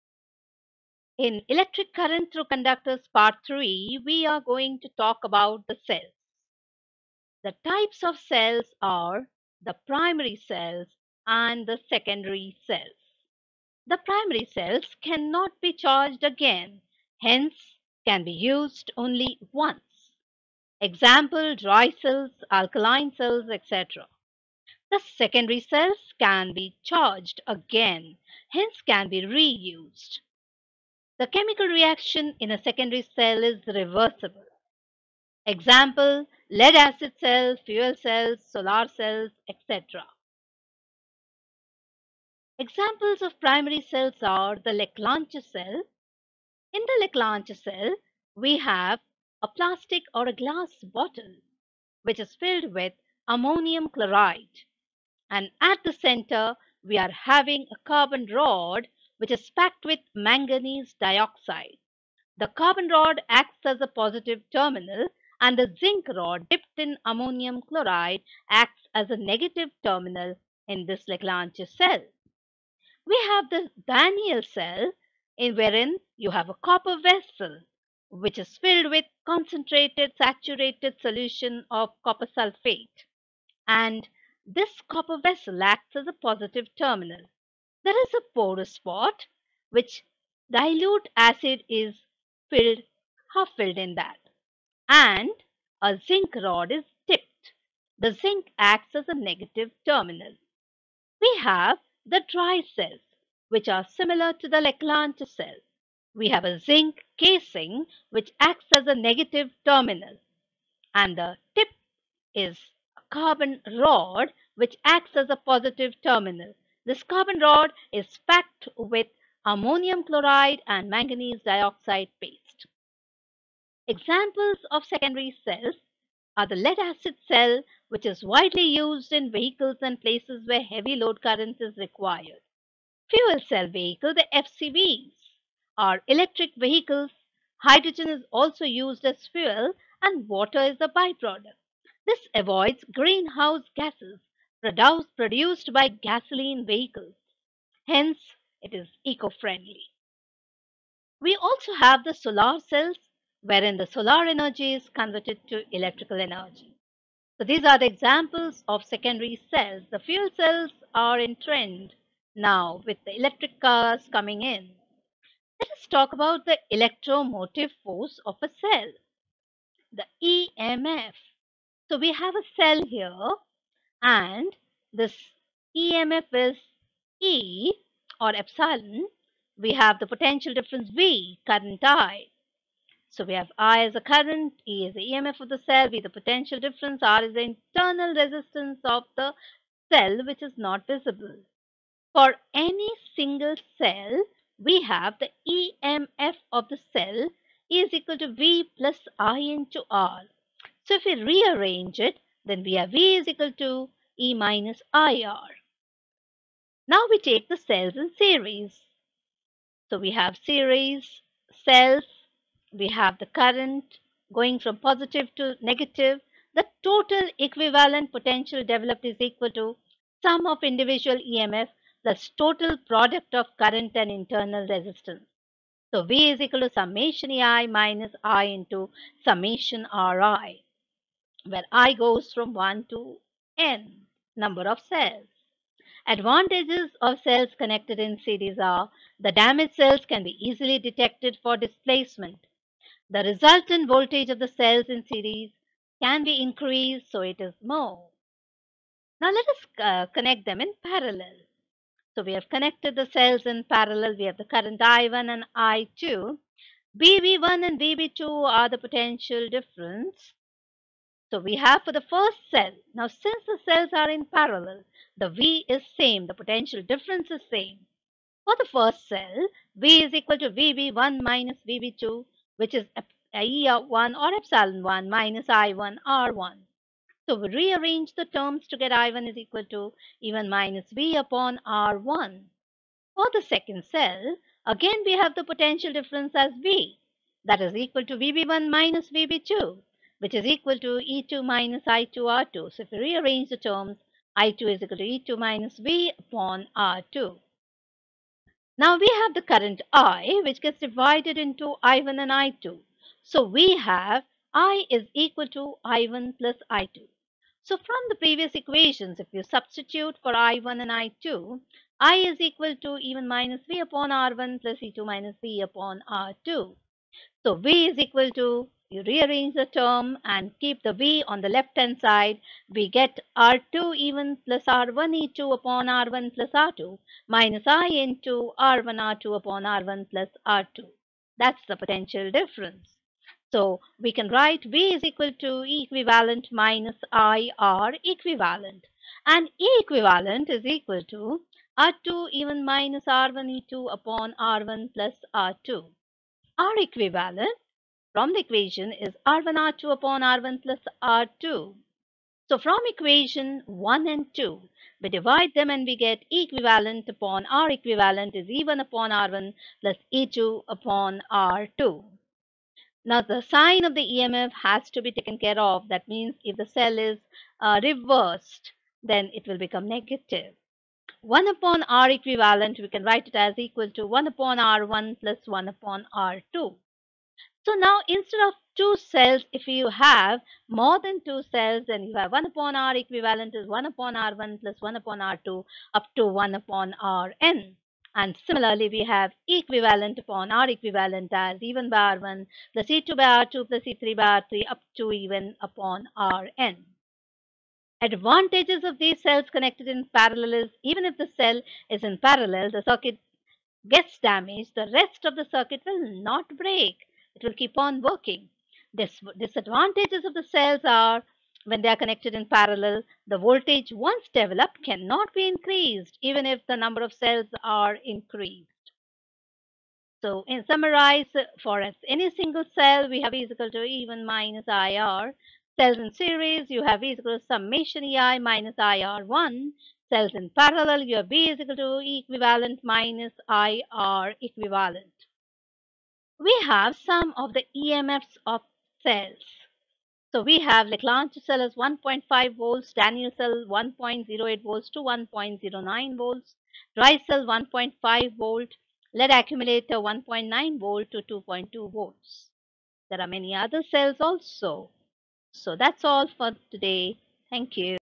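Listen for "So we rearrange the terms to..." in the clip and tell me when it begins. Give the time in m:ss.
4:37.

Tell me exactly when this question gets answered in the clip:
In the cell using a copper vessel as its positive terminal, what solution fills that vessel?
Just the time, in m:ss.
1:22.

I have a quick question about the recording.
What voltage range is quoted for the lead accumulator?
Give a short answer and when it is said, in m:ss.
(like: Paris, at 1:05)
1.9 to 2.2 volts, at 7:29.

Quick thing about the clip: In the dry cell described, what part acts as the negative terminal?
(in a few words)
zinc casing.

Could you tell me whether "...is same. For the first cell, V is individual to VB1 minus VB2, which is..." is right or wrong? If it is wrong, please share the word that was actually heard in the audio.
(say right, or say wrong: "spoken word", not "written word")
wrong: "equal", not "individual".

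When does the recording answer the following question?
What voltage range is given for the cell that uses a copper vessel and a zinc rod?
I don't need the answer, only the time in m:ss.
7:23.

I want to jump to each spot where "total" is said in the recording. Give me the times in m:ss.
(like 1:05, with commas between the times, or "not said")
3:36, 3:42.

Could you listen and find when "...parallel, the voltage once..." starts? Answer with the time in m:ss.
6:52.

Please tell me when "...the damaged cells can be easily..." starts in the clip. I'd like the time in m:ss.
3:59.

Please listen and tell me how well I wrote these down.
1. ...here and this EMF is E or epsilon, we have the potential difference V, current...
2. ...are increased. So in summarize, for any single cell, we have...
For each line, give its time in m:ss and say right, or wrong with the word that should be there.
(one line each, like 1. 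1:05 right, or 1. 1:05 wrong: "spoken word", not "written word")
1. 2:52 right
2. 6:57 right.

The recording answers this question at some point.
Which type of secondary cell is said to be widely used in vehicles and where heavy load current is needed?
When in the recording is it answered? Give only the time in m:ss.
2:06.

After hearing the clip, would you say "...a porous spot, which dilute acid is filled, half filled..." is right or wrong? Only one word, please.
right.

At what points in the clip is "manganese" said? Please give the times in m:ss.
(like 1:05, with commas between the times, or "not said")
1:00, 2:00.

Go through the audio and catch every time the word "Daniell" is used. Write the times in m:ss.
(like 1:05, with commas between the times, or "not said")
1:13, 7:22.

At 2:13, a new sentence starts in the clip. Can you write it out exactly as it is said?
Fuel cell vehicle, the FCVs, are electric vehicles.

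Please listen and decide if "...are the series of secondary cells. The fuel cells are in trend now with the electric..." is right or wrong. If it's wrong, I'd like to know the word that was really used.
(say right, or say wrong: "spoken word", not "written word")
wrong: "examples", not "series".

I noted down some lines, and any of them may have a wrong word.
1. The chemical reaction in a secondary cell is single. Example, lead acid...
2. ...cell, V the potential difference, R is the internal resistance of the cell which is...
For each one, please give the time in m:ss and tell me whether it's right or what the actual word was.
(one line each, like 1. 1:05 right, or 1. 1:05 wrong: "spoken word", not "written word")
1. 0:31 wrong: "reversible", not "single"
2. 3:05 right.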